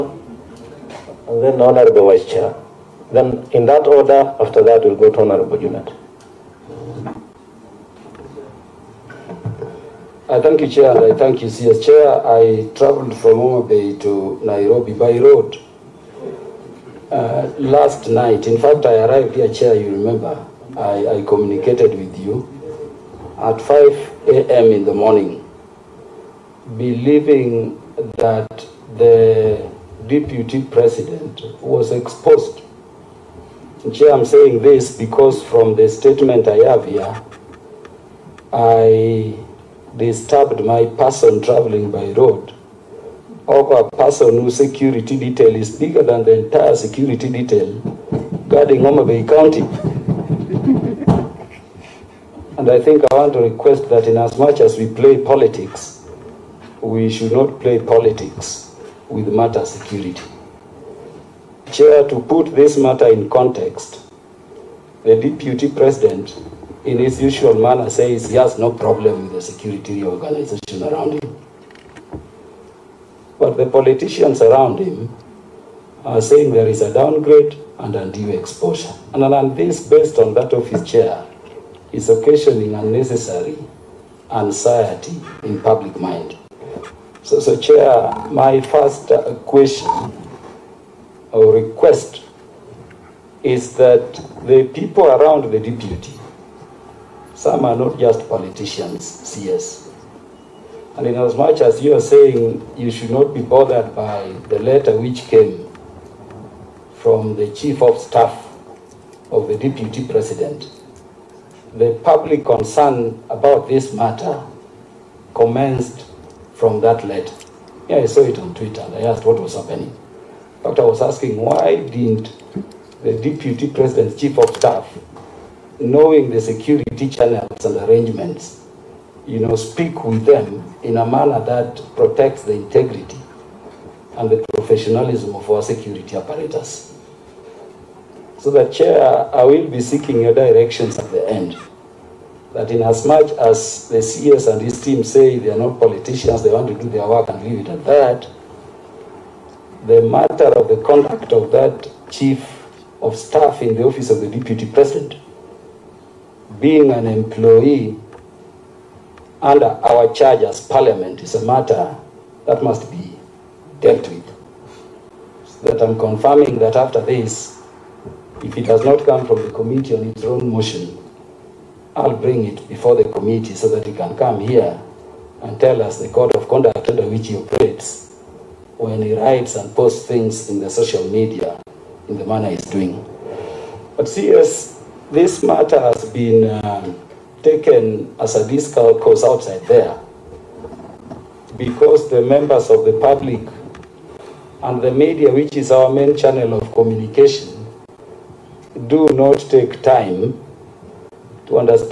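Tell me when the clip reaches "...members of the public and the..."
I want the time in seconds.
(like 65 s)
192 s.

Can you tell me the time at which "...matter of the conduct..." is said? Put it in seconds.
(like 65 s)
150 s.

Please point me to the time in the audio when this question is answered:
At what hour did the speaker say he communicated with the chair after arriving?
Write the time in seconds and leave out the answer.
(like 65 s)
23 s.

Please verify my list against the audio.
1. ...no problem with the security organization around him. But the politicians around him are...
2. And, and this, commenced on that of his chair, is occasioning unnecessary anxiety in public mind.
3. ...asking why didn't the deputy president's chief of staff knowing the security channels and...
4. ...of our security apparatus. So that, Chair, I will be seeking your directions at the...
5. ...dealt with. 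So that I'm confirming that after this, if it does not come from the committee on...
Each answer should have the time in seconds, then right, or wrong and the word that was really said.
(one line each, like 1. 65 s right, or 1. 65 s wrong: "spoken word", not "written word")
1. 68 s right
2. 79 s wrong: "based", not "commenced"
3. 121 s right
4. 135 s right
5. 163 s right.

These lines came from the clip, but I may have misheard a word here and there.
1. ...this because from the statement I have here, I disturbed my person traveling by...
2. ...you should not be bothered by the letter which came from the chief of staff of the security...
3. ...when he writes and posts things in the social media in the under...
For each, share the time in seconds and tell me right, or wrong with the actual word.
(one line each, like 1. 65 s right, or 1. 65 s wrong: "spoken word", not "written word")
1. 34 s right
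2. 102 s wrong: "deputy", not "security"
3. 178 s wrong: "manner", not "under".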